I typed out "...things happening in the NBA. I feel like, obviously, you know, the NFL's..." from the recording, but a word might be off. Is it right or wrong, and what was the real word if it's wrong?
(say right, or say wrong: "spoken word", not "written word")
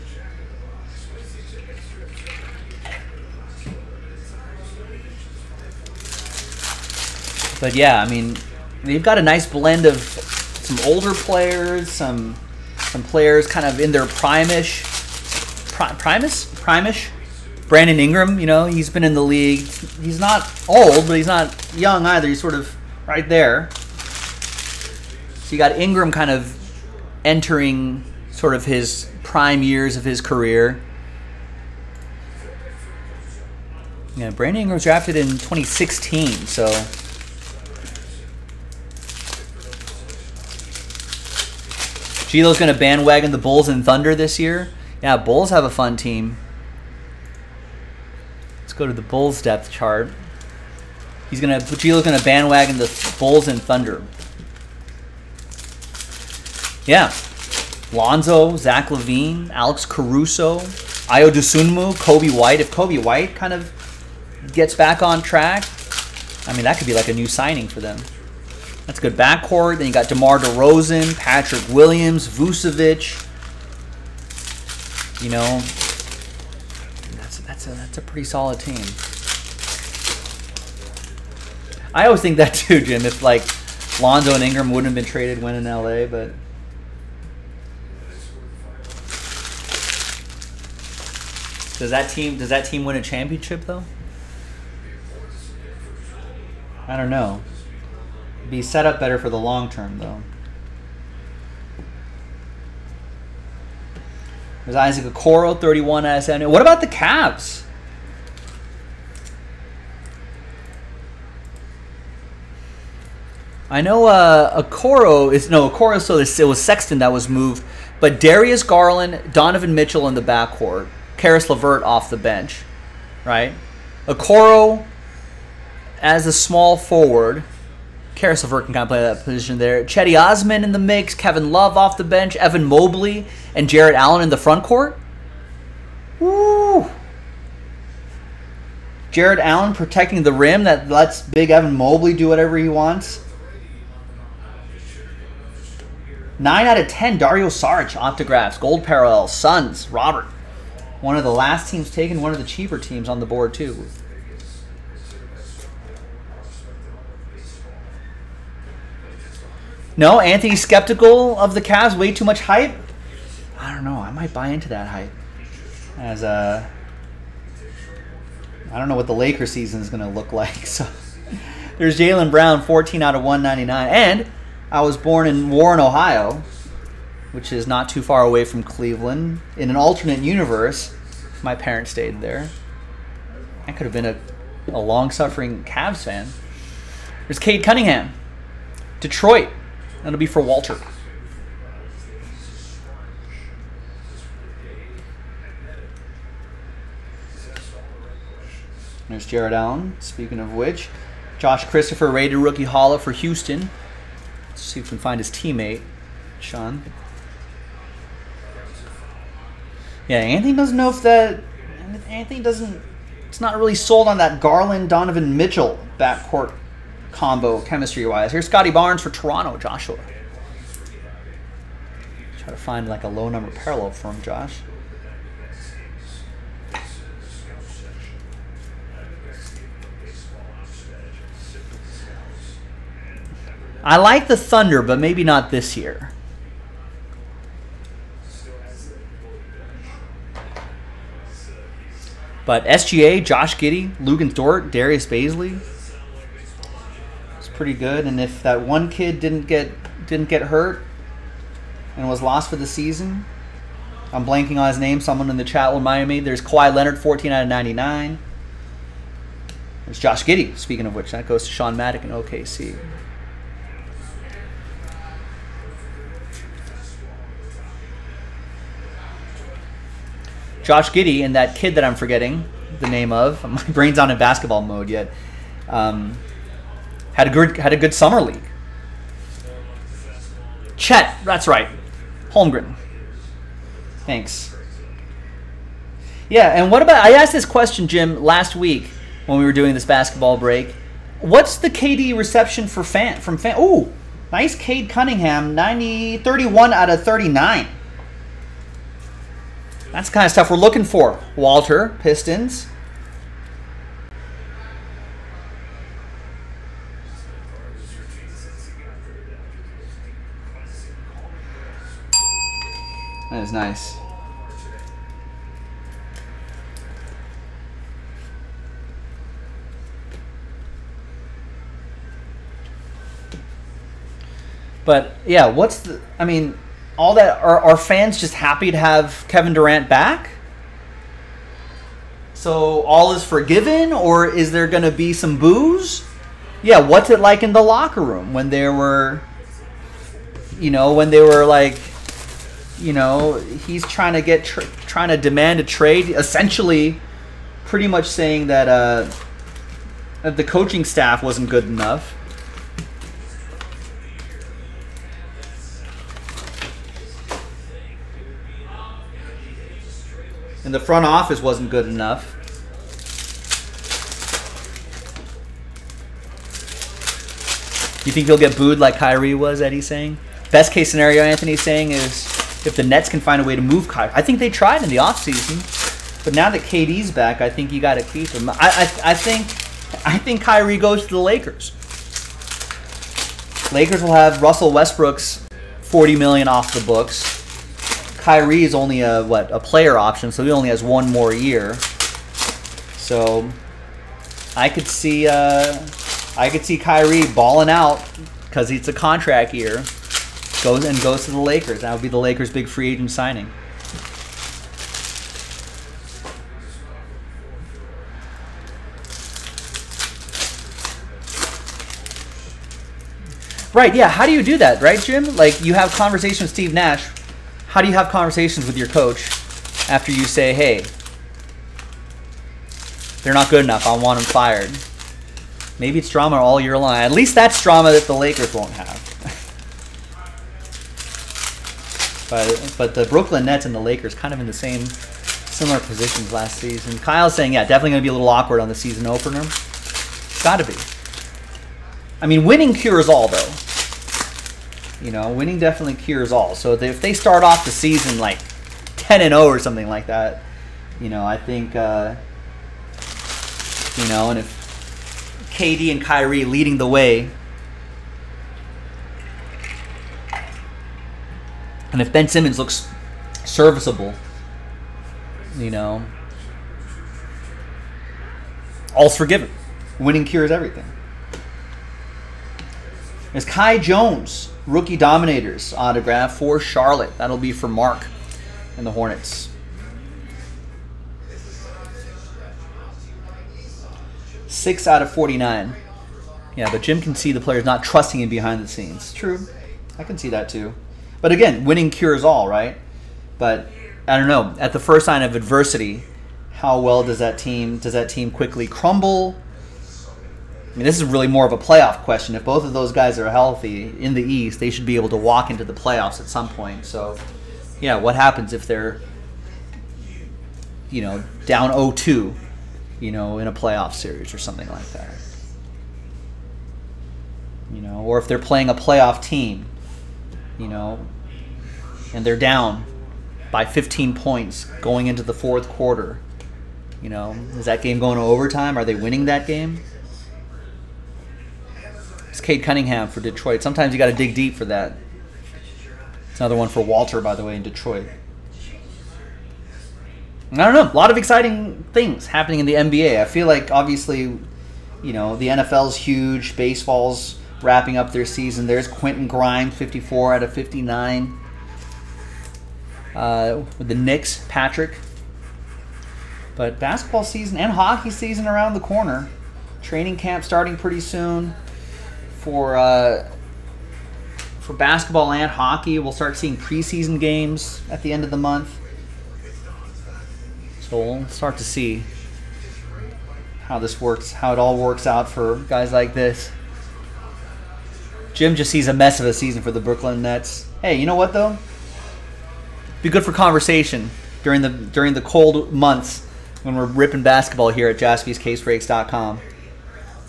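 right.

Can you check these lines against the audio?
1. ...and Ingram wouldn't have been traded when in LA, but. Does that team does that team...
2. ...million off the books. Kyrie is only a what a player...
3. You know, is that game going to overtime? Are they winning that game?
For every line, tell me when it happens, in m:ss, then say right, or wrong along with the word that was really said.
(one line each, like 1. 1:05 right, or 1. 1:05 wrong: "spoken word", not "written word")
1. 1:24 right
2. 6:26 right
3. 8:47 right.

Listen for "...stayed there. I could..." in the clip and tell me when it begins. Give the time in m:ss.
3:01.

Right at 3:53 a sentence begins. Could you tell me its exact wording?
I like the Thunder, but maybe not this year.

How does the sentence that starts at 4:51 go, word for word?
What's the KD reception for fan from fan?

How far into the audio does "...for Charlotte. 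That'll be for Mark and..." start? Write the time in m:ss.
7:56.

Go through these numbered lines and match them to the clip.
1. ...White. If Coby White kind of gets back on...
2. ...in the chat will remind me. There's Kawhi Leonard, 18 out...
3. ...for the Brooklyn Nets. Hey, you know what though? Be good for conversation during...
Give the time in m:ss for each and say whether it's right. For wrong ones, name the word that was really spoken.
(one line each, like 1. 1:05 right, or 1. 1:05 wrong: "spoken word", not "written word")
1. 1:02 right
2. 4:15 wrong: "14", not "18"
3. 9:39 right.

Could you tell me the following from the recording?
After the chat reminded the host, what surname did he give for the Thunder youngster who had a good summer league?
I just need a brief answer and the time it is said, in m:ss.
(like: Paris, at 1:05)
Holmgren, at 4:42.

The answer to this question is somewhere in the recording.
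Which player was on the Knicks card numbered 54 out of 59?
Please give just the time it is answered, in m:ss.
9:08.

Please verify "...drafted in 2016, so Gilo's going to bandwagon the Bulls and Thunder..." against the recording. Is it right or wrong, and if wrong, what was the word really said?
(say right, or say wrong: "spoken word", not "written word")
right.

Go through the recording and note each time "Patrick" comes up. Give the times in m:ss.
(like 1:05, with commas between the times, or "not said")
1:11, 9:14.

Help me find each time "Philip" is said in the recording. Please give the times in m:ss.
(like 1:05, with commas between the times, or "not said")
not said.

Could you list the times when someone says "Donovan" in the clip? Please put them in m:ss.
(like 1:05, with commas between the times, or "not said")
1:59, 3:34.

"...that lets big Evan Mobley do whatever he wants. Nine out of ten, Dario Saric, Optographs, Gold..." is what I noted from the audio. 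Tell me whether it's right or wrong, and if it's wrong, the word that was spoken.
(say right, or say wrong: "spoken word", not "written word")
right.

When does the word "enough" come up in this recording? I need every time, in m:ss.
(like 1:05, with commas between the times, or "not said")
5:51, 6:01, 7:03.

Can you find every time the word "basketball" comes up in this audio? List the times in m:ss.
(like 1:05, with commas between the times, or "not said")
4:34, 4:49, 9:16, 9:24, 9:47.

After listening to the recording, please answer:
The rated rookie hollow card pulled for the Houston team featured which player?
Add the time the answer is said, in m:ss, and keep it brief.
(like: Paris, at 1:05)
Josh Christopher, at 3:21.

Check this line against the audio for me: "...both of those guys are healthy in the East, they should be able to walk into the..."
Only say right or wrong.
right.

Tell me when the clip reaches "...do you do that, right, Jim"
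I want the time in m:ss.
6:54.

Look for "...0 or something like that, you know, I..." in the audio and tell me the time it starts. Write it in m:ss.
7:29.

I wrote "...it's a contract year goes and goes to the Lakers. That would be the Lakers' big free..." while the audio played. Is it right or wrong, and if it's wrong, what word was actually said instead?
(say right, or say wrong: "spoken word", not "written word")
right.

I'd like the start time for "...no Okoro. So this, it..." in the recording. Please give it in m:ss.
1:55.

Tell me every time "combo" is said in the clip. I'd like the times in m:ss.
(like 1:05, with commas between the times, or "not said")
3:37.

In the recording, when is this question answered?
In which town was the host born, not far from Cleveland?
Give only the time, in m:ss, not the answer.
2:55.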